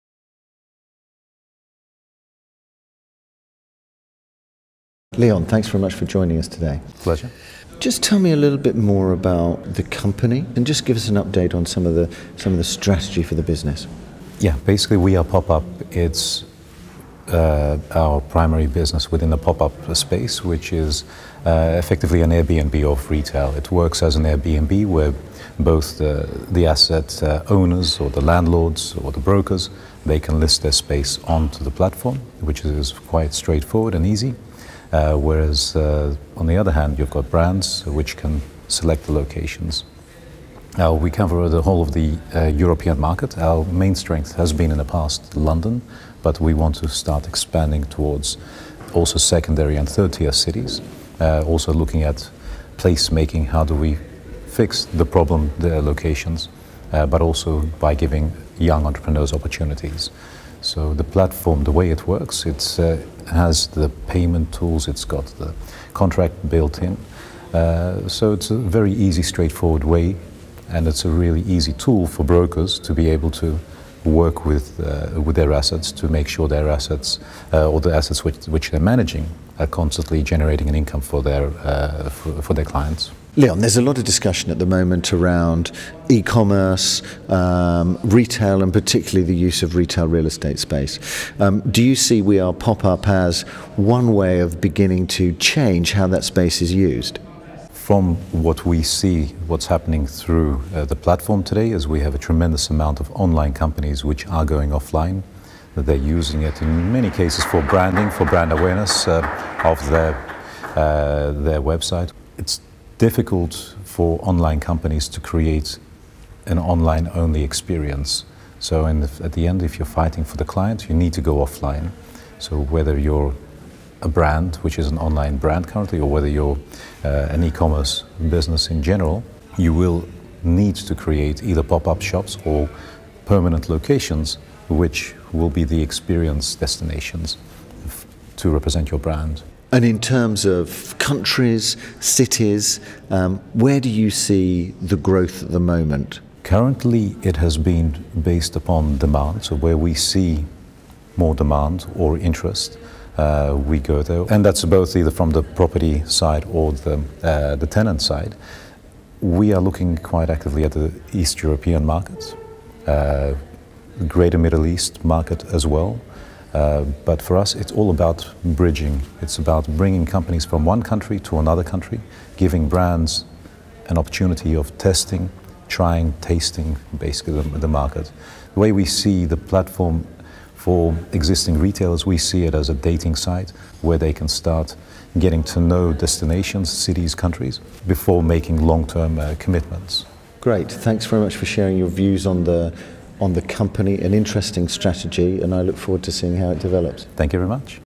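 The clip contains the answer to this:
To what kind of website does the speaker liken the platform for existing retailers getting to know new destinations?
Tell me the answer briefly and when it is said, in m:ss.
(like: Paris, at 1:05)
A dating site, at 3:02.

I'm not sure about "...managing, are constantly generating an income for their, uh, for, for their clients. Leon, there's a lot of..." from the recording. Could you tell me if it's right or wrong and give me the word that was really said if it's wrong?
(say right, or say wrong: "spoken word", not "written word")
right.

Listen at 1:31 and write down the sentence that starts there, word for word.
Um, do you see We Are Pop Up as one way of beginning to change how that space is used?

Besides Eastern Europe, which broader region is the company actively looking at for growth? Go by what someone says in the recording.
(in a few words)
Greater Middle East.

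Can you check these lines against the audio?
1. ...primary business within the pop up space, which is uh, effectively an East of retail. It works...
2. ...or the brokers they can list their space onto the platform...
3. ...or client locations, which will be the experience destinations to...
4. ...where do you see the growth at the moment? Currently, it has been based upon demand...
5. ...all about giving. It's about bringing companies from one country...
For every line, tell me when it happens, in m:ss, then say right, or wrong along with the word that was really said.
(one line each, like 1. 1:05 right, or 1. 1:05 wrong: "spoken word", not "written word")
1. 0:18 wrong: "Airbnb", not "East"
2. 0:28 right
3. 2:12 wrong: "permanent", not "client"
4. 2:23 right
5. 2:47 wrong: "bridging", not "giving".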